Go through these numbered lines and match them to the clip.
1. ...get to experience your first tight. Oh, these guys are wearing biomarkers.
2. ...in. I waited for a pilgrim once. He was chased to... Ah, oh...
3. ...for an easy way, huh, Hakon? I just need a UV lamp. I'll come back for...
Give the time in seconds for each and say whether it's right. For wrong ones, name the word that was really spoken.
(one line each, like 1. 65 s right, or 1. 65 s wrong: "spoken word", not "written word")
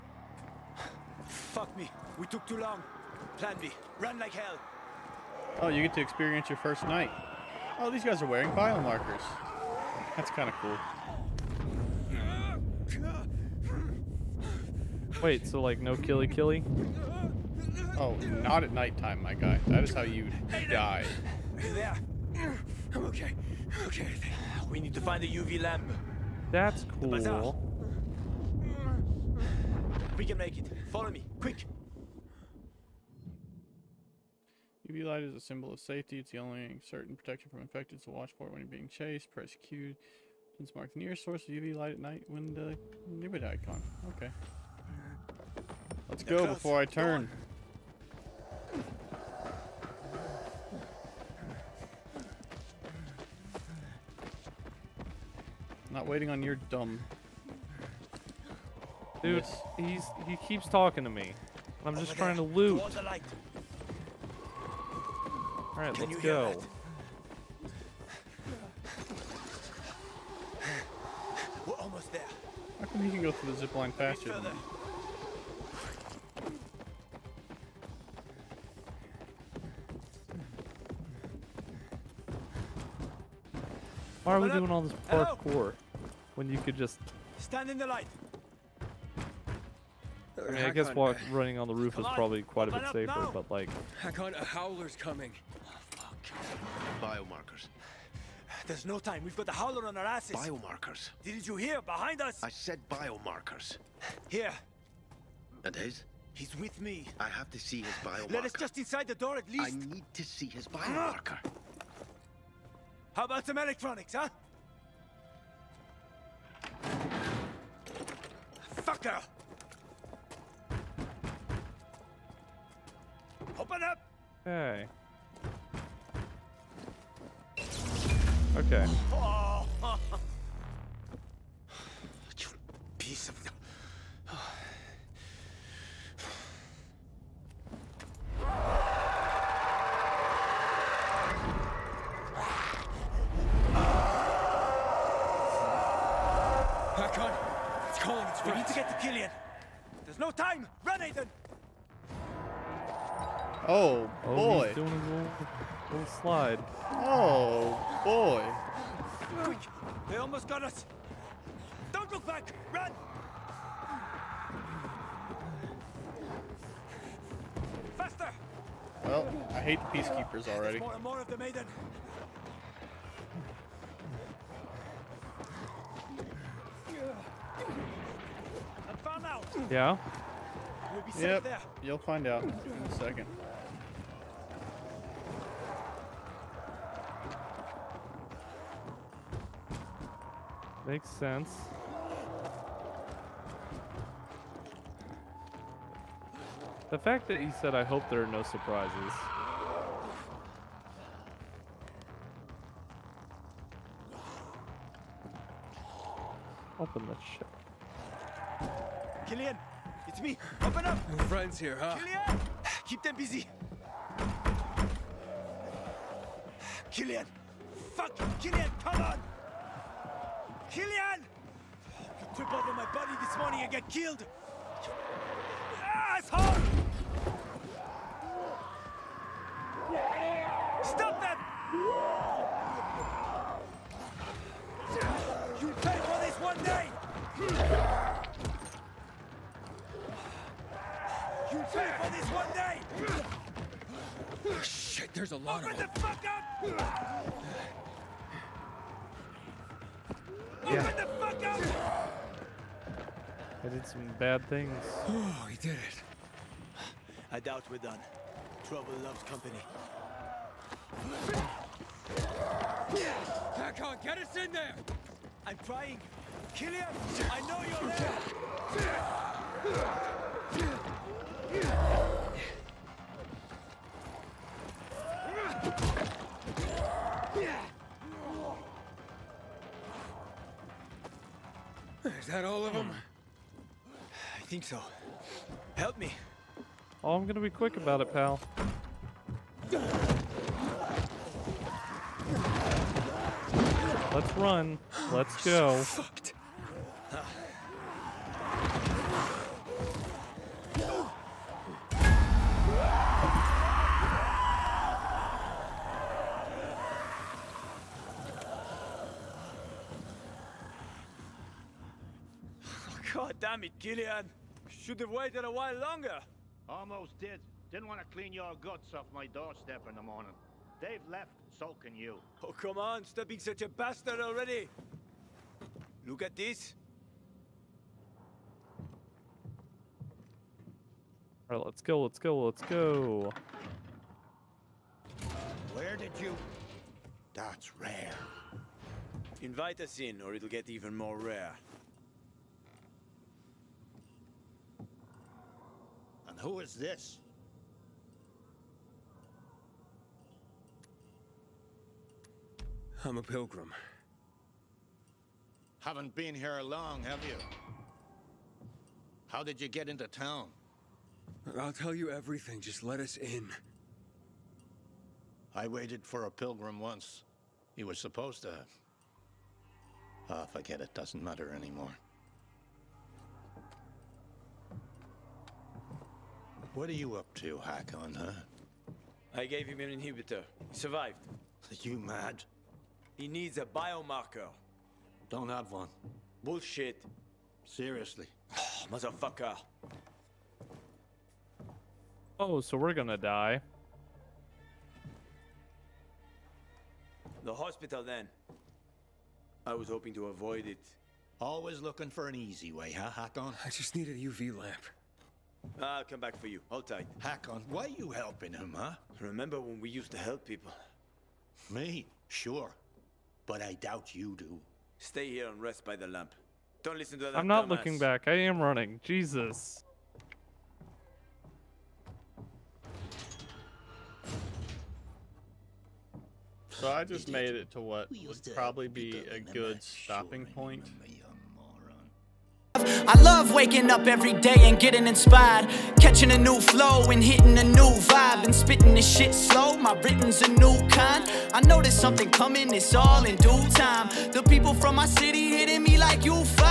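1. 5 s wrong: "night", not "tight"
2. 363 s wrong: "supposed", not "chased"
3. 402 s right.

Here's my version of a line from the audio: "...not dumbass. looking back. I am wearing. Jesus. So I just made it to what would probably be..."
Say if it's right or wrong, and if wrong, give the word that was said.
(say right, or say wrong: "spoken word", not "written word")
wrong: "running", not "wearing".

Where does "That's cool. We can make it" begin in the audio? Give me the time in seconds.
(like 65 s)
26 s.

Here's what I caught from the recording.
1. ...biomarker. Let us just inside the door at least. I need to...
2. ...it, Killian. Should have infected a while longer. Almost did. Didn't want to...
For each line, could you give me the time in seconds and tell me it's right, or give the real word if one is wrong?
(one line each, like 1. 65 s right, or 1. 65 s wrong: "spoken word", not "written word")
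1. 108 s right
2. 313 s wrong: "waited", not "infected".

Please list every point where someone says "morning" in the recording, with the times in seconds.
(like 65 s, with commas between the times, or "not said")
223 s, 320 s.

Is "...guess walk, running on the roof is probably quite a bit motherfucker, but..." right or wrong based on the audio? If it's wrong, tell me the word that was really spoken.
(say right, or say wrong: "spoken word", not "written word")
wrong: "safer", not "motherfucker".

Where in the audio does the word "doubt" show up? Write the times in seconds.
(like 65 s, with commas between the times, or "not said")
257 s, 413 s.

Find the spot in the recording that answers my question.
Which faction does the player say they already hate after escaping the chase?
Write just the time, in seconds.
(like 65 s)
169 s.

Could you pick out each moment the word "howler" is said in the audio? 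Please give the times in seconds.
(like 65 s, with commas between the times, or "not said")
94 s, 99 s.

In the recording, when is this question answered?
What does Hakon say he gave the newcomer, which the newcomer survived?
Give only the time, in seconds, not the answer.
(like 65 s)
379 s.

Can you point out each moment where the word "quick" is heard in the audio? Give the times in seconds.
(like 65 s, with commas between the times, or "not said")
31 s, 159 s, 287 s.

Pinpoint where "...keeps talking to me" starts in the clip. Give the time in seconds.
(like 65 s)
60 s.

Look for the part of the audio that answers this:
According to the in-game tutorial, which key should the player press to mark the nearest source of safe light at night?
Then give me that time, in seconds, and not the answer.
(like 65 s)
39 s.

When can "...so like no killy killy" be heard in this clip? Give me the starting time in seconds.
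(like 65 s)
15 s.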